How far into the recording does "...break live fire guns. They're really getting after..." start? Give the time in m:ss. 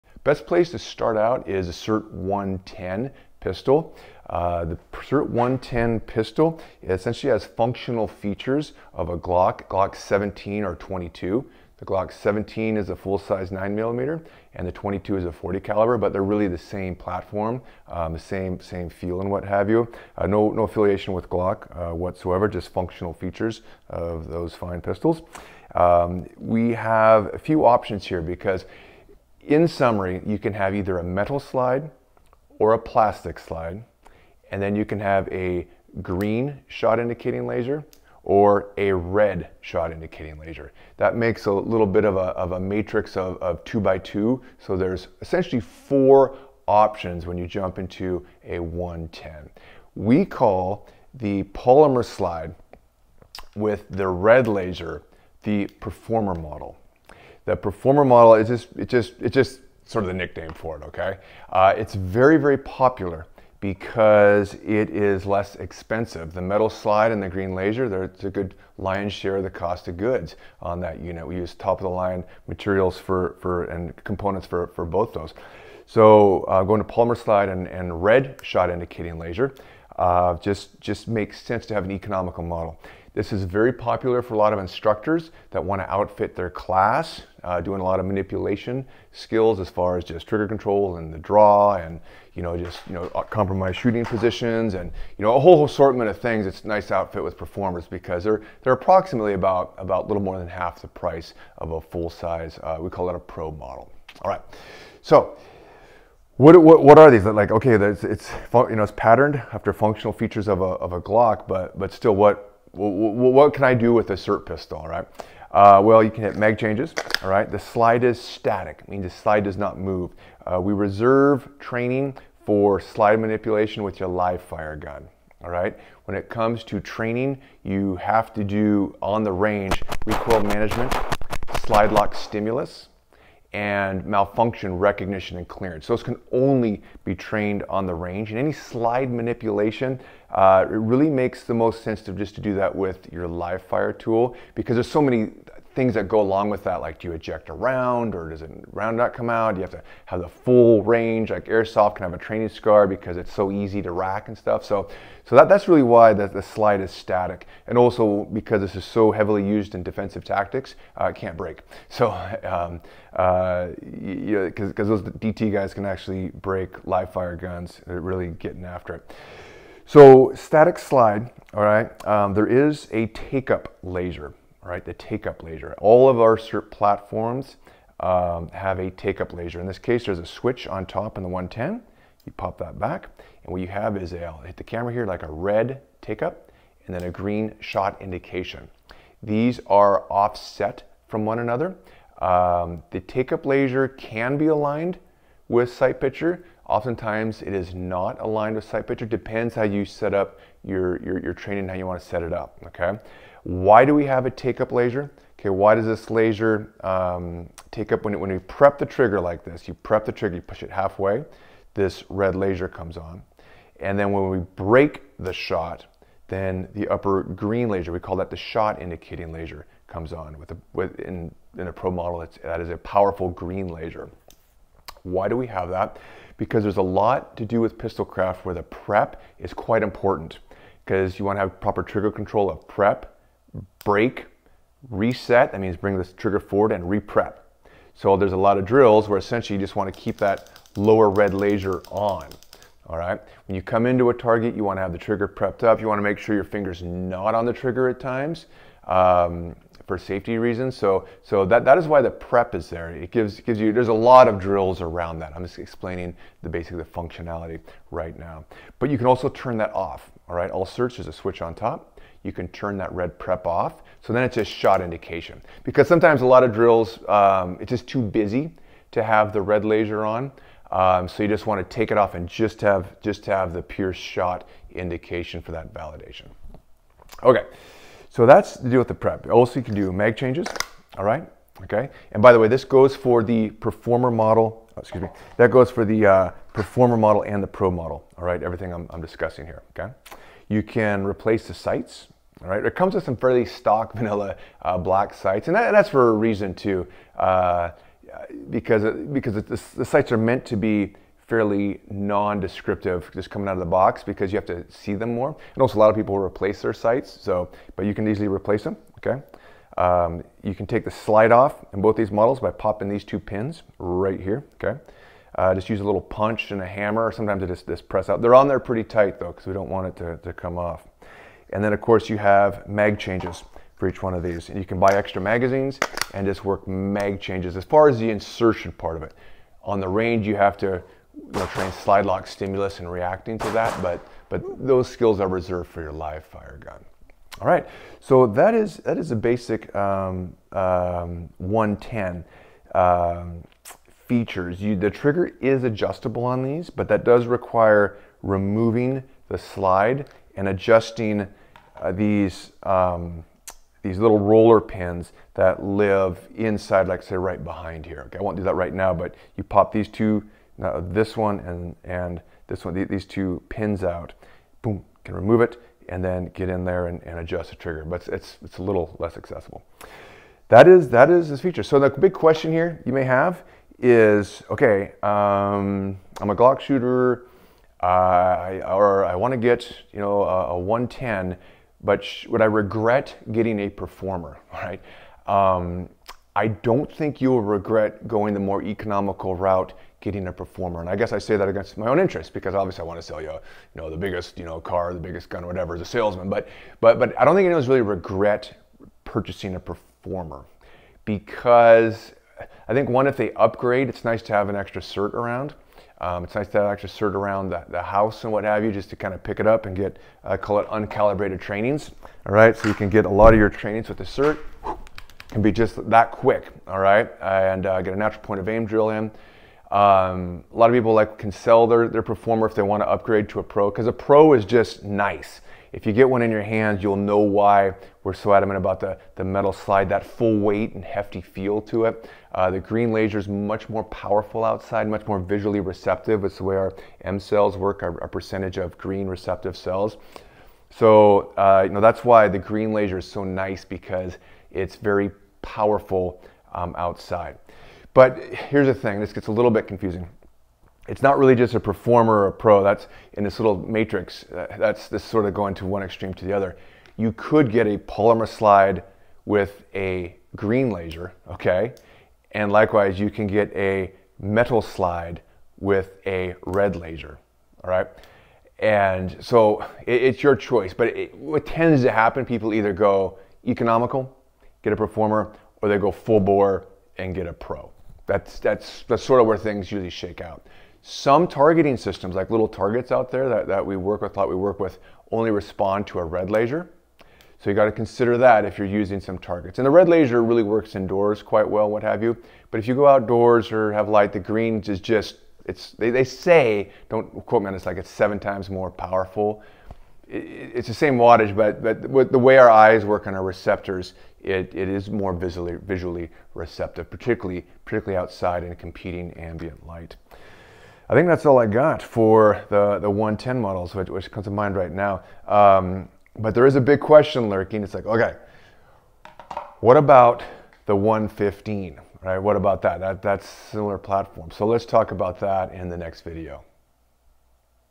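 2:46.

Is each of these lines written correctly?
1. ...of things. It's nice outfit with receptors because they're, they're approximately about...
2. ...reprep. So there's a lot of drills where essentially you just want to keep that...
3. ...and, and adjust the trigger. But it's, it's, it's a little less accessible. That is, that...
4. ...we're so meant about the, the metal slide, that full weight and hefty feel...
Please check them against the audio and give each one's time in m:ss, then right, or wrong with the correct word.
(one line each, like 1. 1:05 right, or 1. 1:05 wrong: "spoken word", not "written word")
1. 1:36 wrong: "performers", not "receptors"
2. 3:56 right
3. 6:06 right
4. 7:08 wrong: "adamant", not "meant".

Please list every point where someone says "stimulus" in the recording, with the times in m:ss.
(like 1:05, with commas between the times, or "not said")
2:12, 5:32.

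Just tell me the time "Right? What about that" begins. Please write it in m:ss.
8:42.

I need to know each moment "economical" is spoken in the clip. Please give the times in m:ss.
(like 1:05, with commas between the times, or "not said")
1:21, 6:28, 7:53.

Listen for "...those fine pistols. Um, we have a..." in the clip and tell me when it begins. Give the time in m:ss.
0:24.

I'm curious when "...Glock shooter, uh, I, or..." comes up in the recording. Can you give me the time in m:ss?
6:16.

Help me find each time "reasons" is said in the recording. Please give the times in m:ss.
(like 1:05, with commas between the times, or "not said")
4:10, 4:56.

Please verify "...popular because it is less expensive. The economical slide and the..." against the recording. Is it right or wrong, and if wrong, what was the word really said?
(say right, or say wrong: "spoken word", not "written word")
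wrong: "metal", not "economical".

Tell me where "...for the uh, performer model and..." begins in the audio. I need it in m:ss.
4:45.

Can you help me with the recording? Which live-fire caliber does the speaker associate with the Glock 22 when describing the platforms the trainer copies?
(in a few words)
40 caliber.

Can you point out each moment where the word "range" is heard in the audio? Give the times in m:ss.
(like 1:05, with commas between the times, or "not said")
2:09, 2:17, 2:30, 5:29.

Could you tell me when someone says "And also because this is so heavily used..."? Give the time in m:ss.
2:37.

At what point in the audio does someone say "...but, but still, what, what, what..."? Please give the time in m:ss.
1:51.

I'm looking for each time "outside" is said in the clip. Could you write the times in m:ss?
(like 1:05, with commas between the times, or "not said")
7:14, 7:26, 8:27.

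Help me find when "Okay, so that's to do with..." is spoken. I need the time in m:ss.
4:37.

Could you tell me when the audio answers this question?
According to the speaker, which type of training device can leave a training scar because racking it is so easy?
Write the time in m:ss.
2:31.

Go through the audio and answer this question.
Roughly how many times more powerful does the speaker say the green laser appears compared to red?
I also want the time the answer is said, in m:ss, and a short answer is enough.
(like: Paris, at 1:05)
7, at 8:17.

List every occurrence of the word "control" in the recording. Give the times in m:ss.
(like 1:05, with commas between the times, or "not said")
1:30, 3:52.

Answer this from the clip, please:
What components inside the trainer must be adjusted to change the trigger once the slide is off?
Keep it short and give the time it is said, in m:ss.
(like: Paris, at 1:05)
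roller pins, at 5:54.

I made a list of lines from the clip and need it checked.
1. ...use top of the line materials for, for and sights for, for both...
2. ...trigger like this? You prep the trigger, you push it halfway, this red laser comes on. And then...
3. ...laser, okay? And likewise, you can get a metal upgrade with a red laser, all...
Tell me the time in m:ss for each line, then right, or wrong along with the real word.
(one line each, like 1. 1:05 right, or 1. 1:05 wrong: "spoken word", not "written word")
1. 1:11 wrong: "components", not "sights"
2. 3:28 right
3. 7:40 wrong: "slide", not "upgrade".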